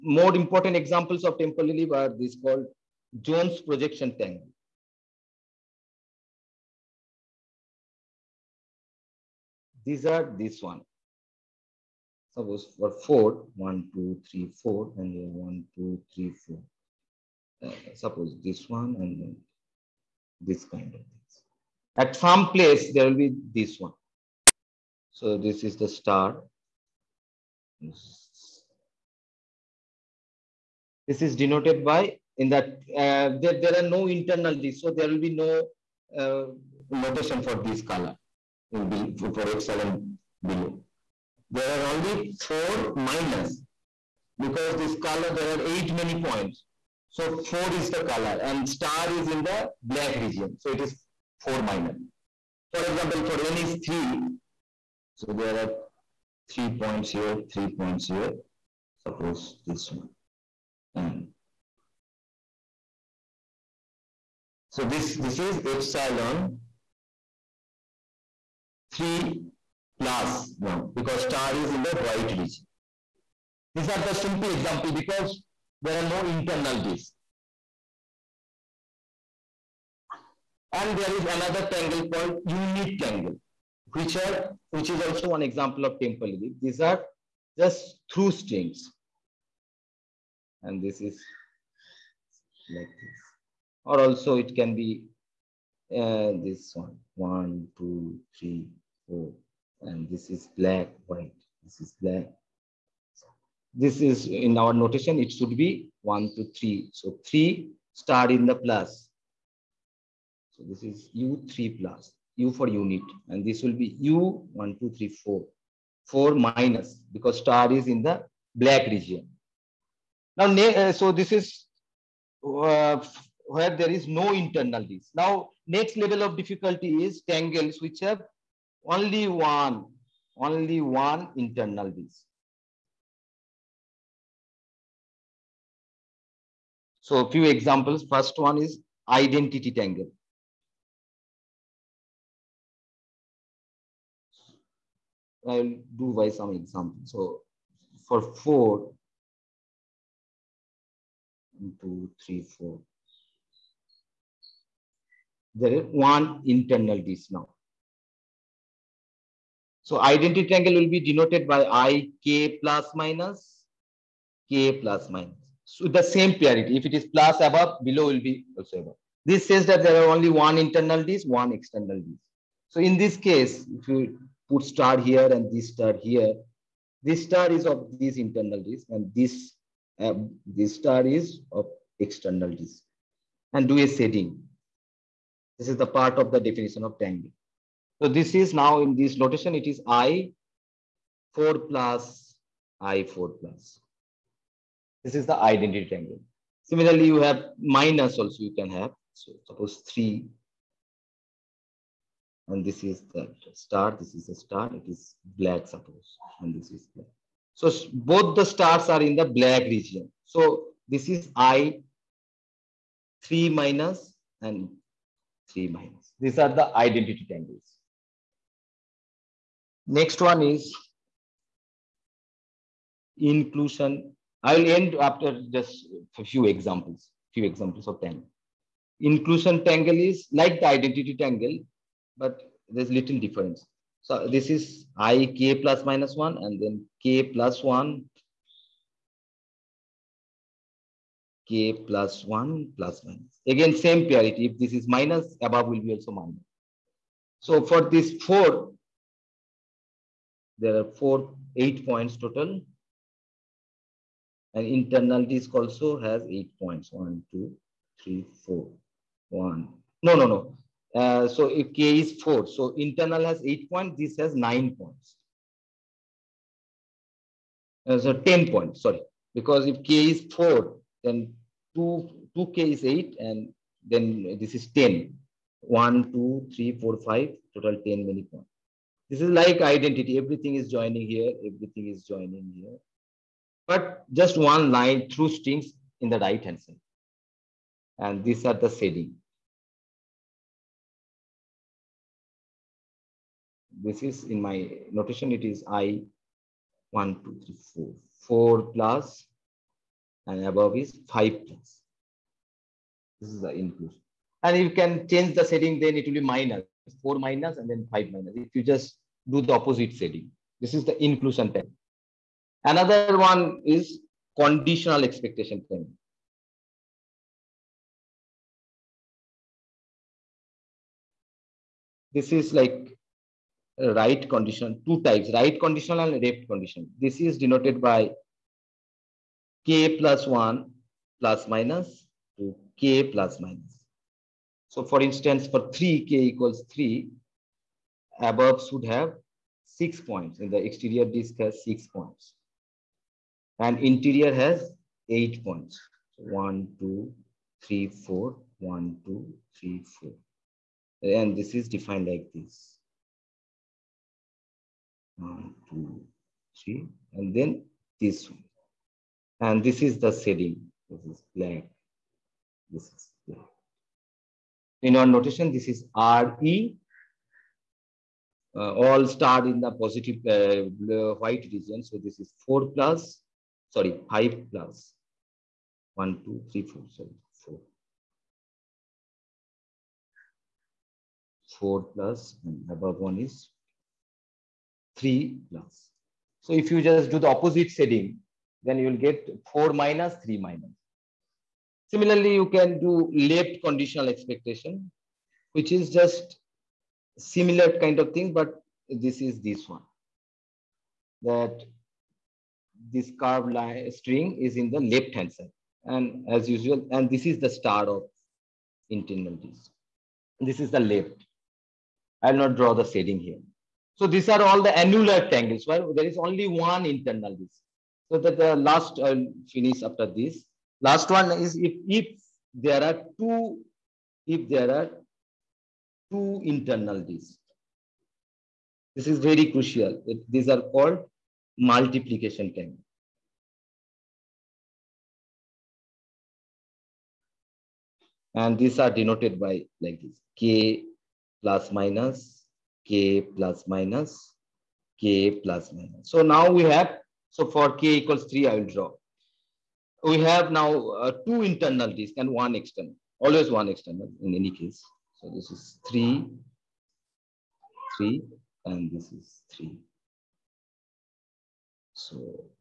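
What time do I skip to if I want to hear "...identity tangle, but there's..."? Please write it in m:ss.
3:50.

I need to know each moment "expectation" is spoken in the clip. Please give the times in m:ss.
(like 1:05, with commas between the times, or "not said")
5:15, 6:34.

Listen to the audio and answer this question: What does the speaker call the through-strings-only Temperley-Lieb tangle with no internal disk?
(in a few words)
unit tangle.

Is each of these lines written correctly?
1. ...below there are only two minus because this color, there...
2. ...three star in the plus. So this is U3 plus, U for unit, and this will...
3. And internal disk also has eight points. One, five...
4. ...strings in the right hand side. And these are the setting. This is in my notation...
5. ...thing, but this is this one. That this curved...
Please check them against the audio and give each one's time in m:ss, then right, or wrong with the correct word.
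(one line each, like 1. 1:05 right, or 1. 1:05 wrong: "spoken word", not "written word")
1. 0:40 wrong: "four", not "two"
2. 1:47 right
3. 4:14 wrong: "two", not "five"
4. 4:45 right
5. 6:38 right.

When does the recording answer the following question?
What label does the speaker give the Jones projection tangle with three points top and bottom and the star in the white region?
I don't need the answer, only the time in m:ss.
1:05.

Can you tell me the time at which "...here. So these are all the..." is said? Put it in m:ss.
6:53.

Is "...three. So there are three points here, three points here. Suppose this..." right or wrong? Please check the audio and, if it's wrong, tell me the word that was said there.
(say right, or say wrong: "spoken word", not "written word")
right.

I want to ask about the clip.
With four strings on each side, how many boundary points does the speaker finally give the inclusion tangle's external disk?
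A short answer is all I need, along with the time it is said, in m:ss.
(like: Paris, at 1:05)
10, at 4:28.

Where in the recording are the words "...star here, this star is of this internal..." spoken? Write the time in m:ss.
2:55.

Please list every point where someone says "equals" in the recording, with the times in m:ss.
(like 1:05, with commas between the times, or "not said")
5:36, 7:27.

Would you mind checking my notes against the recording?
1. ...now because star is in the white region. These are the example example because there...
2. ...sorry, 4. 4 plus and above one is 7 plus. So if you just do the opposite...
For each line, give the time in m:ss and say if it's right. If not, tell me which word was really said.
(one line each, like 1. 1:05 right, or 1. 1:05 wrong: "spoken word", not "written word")
1. 1:10 wrong: "simple", not "example"
2. 6:16 wrong: "3", not "7".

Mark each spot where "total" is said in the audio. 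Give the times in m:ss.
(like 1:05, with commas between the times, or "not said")
4:12, 4:37.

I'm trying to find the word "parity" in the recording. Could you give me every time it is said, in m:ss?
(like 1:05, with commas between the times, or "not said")
2:46, 4:04.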